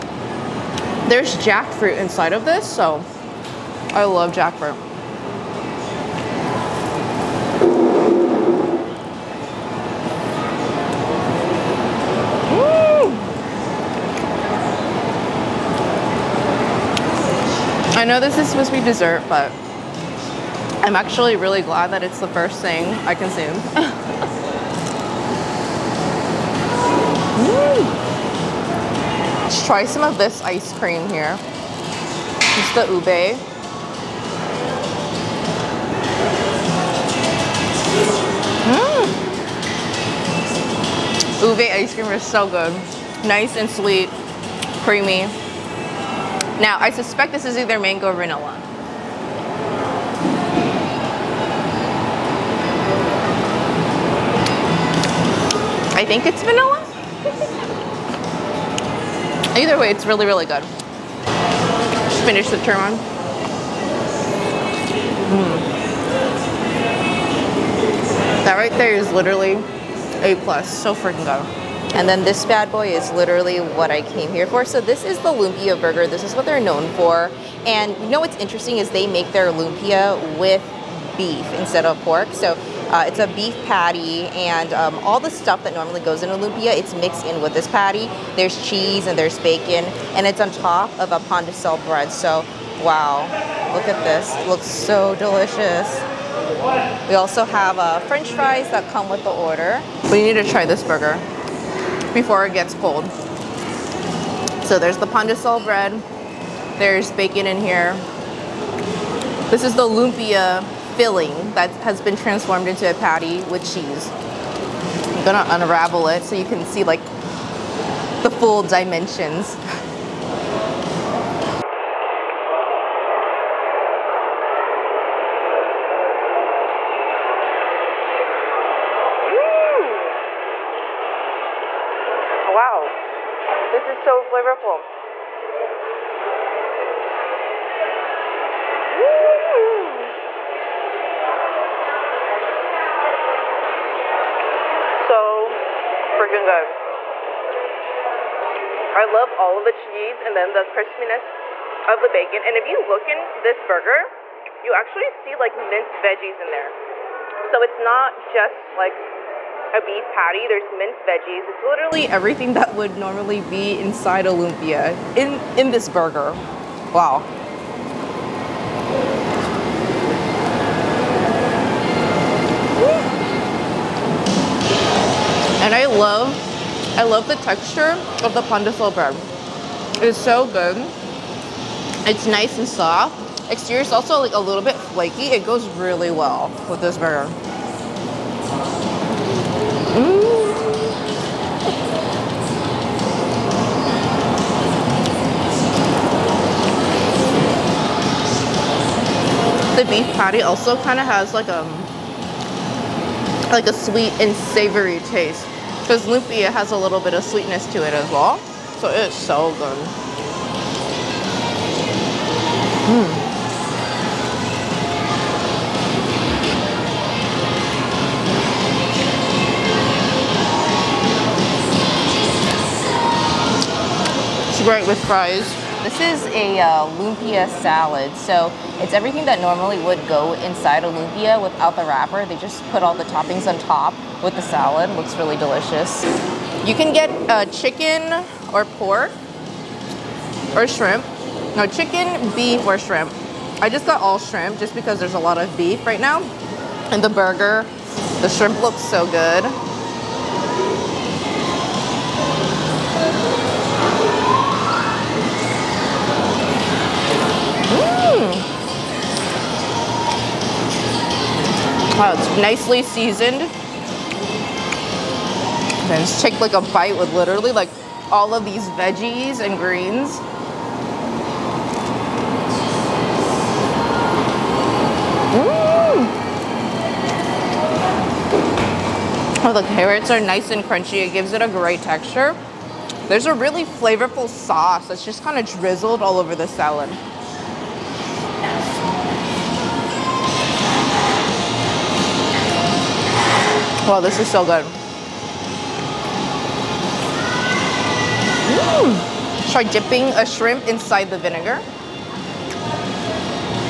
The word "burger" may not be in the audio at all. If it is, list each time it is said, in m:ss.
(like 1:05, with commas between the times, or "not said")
1:15, 1:40, 2:33, 2:45, 3:06, 4:07.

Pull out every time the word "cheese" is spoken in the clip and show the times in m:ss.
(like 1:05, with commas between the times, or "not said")
1:28, 1:53, 2:29.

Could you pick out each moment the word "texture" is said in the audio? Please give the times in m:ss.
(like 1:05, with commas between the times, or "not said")
2:57, 4:41.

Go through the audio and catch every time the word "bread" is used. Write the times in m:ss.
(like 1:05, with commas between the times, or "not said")
1:31, 1:45, 2:58.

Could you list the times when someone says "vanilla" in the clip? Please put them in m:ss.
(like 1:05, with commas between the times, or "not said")
0:48, 0:56.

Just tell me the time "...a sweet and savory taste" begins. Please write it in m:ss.
3:23.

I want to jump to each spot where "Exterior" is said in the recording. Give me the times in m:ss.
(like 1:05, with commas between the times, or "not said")
3:03.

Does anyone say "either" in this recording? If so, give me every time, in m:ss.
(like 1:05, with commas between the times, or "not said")
0:47, 0:59.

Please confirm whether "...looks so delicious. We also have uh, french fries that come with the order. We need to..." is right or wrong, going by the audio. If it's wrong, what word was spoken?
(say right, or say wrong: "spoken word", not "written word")
right.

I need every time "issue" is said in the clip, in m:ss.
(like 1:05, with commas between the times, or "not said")
not said.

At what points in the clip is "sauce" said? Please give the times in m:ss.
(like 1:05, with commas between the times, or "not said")
4:44.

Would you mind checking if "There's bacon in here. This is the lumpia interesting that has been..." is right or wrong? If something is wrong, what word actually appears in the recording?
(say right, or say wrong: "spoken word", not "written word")
wrong: "filling", not "interesting".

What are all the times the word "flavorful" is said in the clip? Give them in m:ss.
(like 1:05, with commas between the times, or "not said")
2:14, 4:43.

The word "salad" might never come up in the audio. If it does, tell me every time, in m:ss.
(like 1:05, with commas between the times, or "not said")
3:47, 3:54, 4:46.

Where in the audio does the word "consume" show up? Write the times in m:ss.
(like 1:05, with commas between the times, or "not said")
0:23.